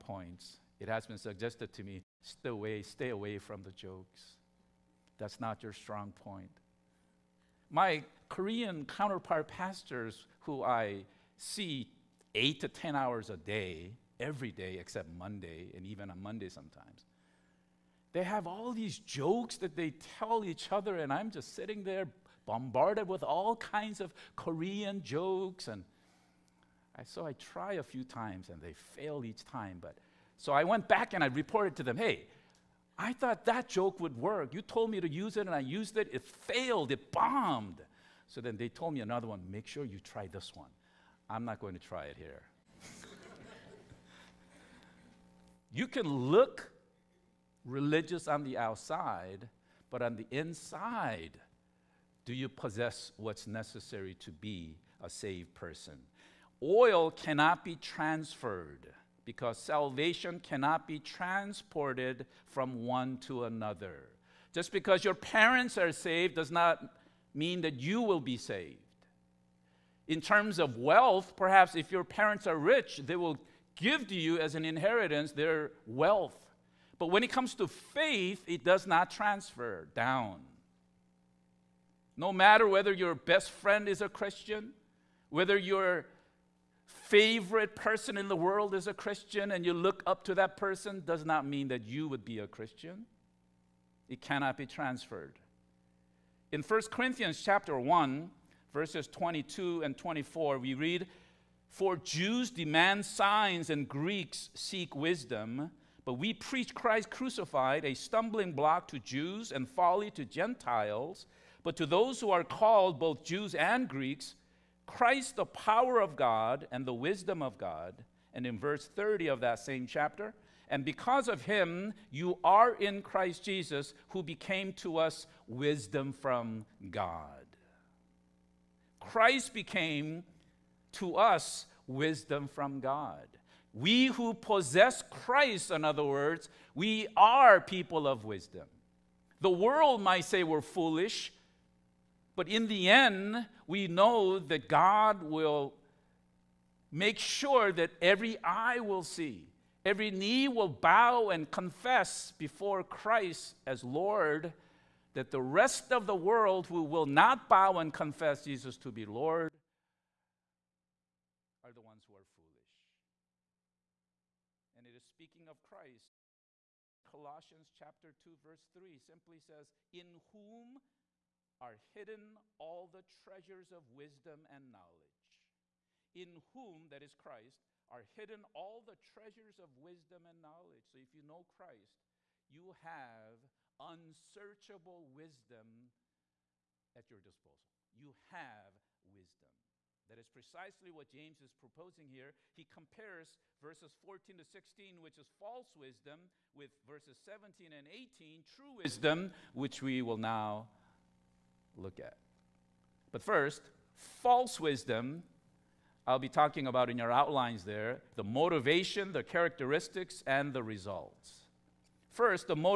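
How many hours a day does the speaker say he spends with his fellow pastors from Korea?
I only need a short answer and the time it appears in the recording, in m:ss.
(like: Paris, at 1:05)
8 to 10, at 0:12.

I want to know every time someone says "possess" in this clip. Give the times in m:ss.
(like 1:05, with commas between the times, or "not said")
0:52, 2:14.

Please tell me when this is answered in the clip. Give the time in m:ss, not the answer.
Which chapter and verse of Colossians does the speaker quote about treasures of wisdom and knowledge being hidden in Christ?
2:47.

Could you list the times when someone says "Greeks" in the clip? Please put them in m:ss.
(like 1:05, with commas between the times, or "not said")
1:43, 1:53.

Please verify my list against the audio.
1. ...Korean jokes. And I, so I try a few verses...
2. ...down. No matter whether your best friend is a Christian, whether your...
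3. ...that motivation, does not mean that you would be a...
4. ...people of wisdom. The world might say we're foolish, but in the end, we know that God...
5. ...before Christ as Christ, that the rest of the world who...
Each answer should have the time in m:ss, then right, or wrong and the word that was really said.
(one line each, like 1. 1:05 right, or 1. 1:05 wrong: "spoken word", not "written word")
1. 0:24 wrong: "times", not "verses"
2. 1:19 right
3. 1:30 wrong: "person", not "motivation"
4. 2:17 right
5. 2:32 wrong: "Lord", not "Christ".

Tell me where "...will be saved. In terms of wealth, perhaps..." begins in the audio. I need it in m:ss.
1:07.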